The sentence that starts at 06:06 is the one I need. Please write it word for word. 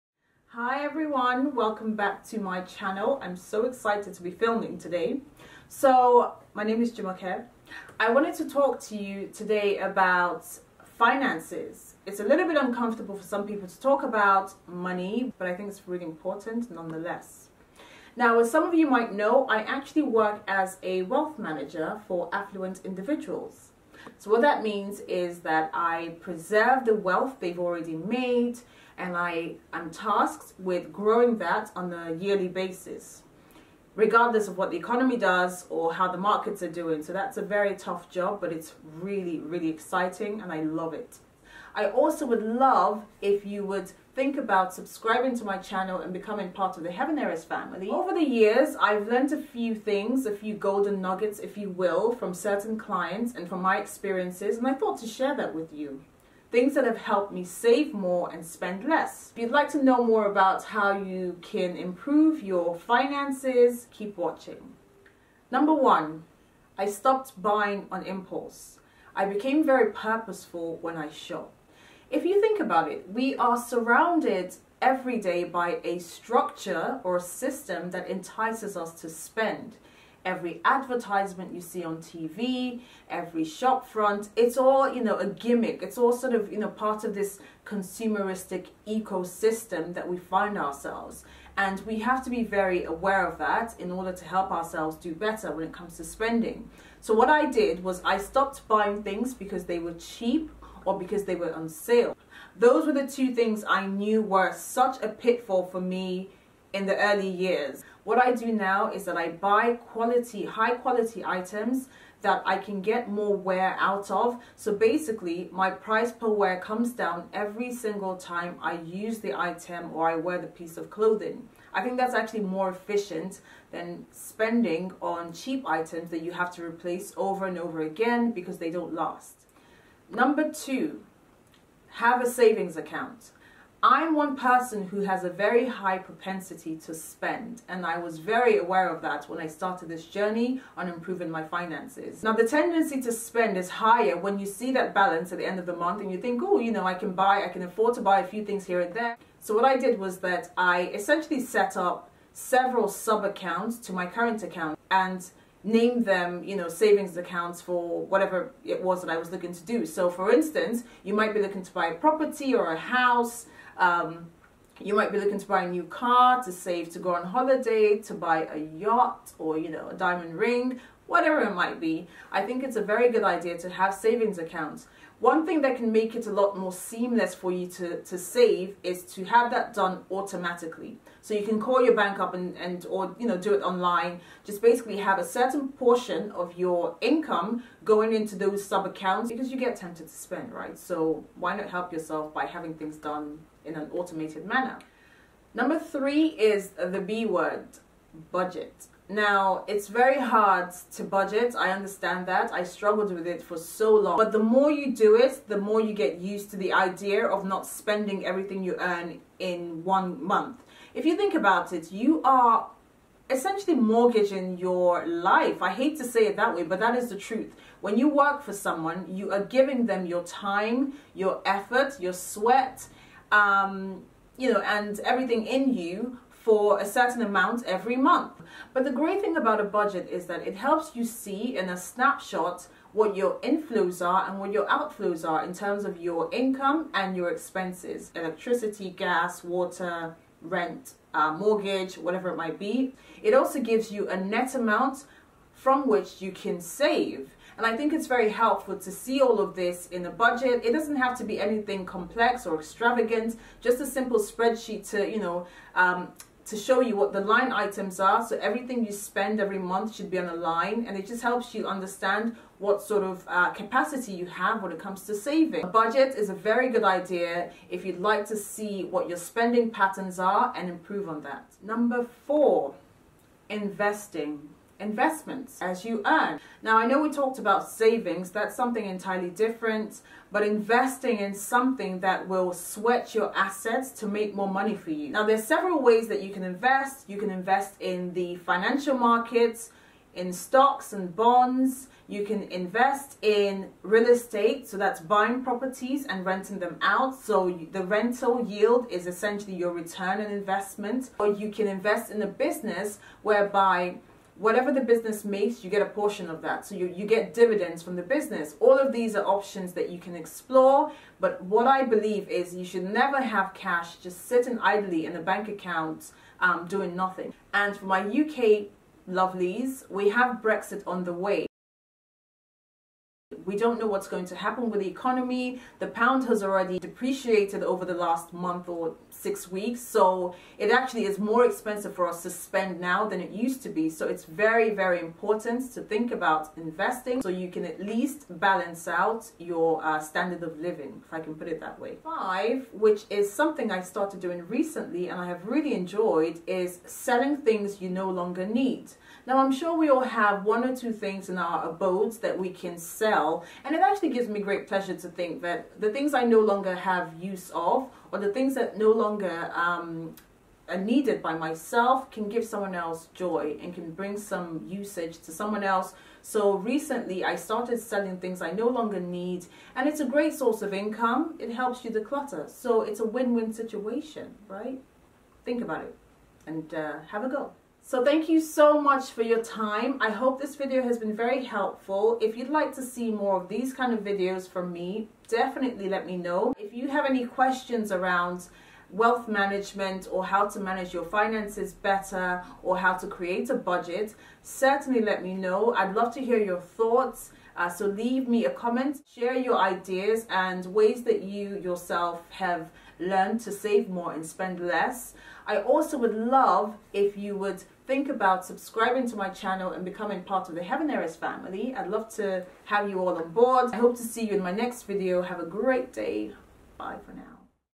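So recently I started selling things I no longer need and it's a great source of income.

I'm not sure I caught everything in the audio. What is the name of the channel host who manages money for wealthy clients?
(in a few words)
Jumoke.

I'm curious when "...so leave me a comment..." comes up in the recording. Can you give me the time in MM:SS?
06:37.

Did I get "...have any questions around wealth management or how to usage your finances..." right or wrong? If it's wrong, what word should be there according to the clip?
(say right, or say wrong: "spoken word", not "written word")
wrong: "manage", not "usage".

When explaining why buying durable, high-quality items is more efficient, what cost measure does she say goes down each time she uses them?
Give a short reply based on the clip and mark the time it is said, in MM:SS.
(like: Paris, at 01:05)
price per wear, at 01:55.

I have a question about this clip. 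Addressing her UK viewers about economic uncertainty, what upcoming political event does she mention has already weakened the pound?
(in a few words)
Brexit.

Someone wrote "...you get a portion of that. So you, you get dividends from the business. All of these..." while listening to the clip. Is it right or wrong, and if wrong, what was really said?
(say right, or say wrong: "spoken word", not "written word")
right.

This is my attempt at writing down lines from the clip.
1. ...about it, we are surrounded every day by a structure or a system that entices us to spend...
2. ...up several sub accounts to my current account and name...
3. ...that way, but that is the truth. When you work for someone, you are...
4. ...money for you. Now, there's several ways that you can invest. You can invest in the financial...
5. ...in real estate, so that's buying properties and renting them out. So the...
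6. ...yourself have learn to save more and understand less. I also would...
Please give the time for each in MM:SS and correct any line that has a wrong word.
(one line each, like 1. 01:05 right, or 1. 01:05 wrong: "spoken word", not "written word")
1. 01:12 right
2. 02:31 right
3. 03:36 right
4. 04:44 right
5. 04:53 right
6. 06:41 wrong: "spend", not "understand".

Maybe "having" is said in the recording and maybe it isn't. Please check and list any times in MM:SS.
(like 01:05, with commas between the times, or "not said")
03:12.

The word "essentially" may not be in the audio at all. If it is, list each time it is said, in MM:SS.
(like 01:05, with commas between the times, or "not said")
02:30, 03:33, 04:59.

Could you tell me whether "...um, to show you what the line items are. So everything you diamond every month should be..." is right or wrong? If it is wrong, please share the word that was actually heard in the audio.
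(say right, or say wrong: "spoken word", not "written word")
wrong: "spend", not "diamond".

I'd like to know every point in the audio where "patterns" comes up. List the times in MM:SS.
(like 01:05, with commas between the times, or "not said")
04:29.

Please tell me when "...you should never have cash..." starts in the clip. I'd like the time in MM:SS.
05:12.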